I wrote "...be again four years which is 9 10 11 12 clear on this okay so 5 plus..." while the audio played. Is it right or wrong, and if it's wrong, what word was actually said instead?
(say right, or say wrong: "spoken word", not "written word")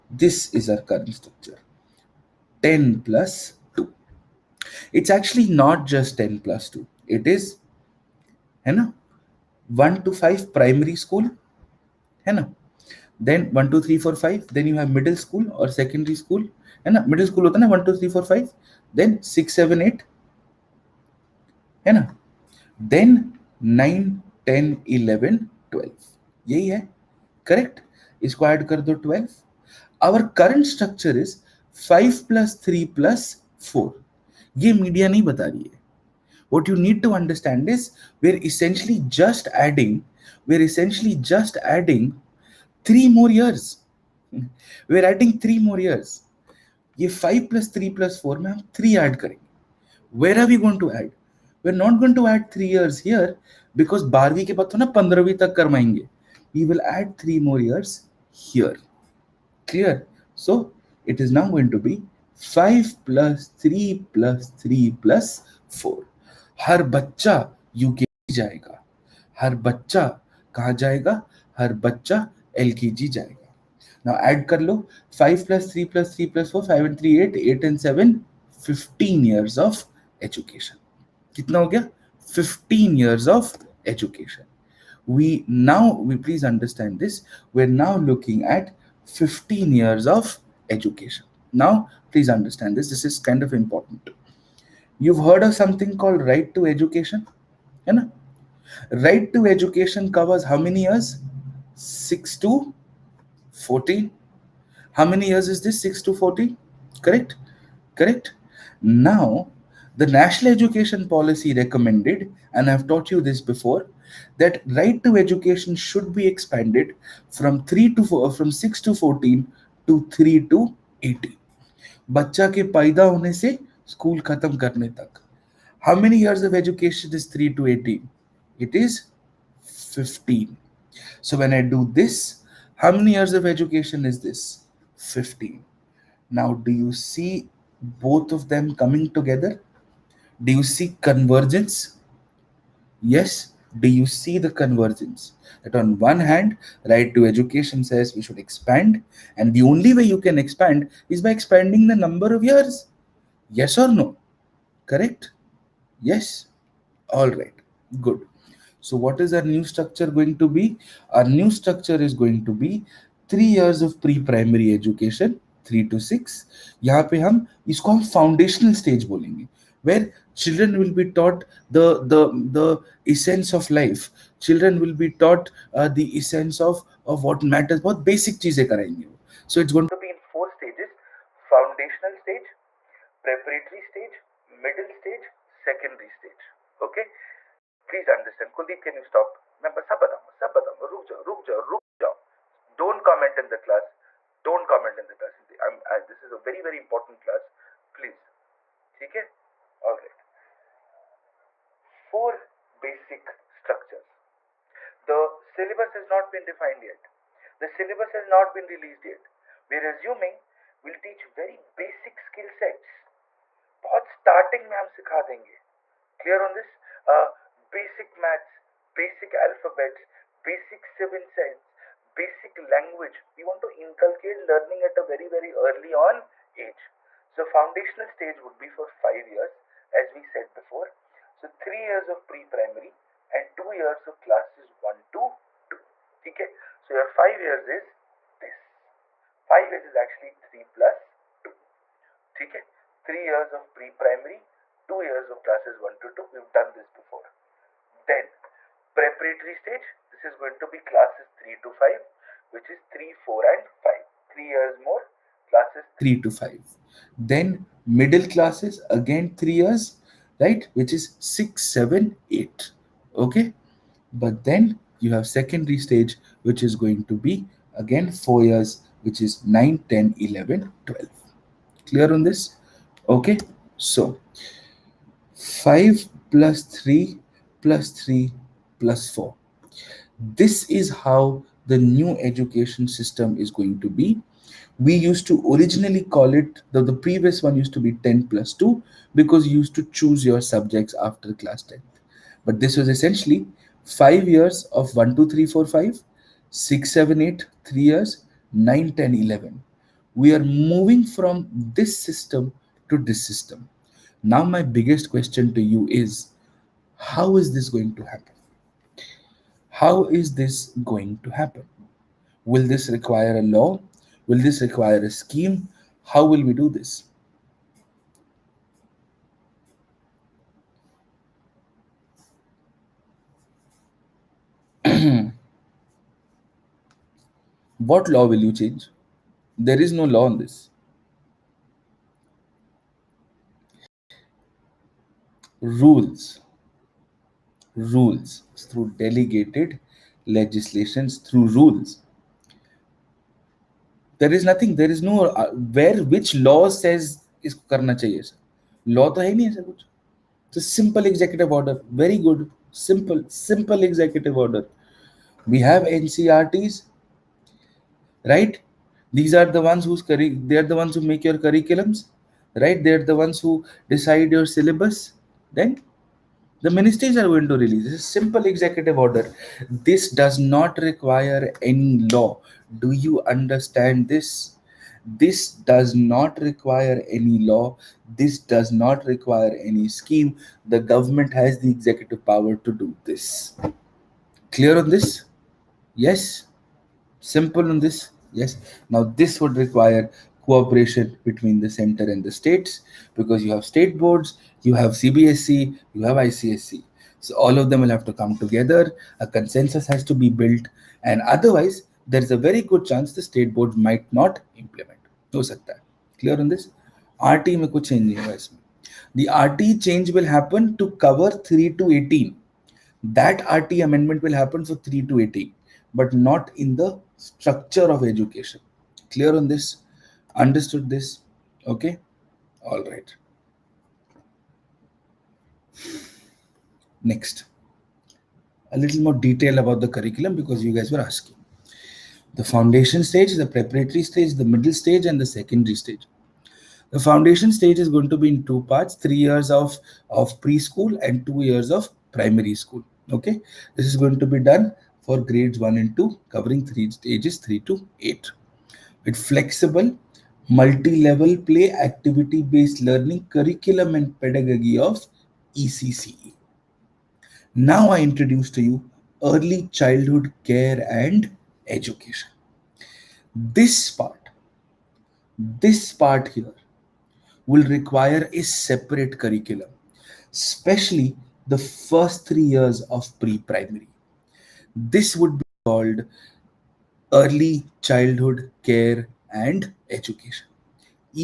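right.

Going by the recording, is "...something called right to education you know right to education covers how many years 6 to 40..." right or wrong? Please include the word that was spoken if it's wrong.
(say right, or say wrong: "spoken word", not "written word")
right.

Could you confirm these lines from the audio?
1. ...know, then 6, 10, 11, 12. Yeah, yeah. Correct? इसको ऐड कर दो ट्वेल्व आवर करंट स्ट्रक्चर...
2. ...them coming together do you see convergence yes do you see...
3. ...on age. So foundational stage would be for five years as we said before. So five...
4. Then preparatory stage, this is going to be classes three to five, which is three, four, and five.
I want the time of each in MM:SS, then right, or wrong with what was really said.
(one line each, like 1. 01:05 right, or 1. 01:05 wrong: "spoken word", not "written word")
1. 00:21 wrong: "9", not "6"
2. 02:18 right
3. 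03:45 wrong: "three", not "five"
4. 04:07 right.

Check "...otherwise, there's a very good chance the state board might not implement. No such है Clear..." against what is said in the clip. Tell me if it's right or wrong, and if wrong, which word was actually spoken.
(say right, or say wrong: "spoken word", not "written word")
right.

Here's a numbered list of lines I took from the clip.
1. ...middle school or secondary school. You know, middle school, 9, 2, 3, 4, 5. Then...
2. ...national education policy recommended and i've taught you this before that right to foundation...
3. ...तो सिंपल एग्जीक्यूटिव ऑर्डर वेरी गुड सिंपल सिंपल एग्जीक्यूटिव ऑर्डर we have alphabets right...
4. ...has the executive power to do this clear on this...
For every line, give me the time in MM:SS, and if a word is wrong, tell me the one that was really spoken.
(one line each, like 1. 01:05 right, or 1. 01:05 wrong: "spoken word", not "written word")
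1. 00:14 wrong: "1", not "9"
2. 01:50 wrong: "education", not "foundation"
3. 05:50 wrong: "ncerts", not "alphabets"
4. 06:21 right.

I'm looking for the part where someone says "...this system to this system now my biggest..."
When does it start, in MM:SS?
05:01.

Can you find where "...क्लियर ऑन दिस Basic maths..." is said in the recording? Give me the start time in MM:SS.
03:36.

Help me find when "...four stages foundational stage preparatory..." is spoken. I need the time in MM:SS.
03:00.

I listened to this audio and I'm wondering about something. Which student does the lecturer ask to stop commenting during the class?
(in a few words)
Kuldeep.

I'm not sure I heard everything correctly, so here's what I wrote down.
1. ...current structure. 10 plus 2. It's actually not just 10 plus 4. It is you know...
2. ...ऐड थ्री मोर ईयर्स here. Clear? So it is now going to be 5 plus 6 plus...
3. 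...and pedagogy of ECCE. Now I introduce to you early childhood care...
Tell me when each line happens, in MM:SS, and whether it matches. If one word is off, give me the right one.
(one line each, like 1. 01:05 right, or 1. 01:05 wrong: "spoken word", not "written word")
1. 00:00 wrong: "2", not "4"
2. 00:56 wrong: "3", not "6"
3. 07:33 right.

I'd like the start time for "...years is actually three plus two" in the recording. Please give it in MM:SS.
03:59.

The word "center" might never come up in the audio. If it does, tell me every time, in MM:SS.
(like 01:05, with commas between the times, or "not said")
06:31.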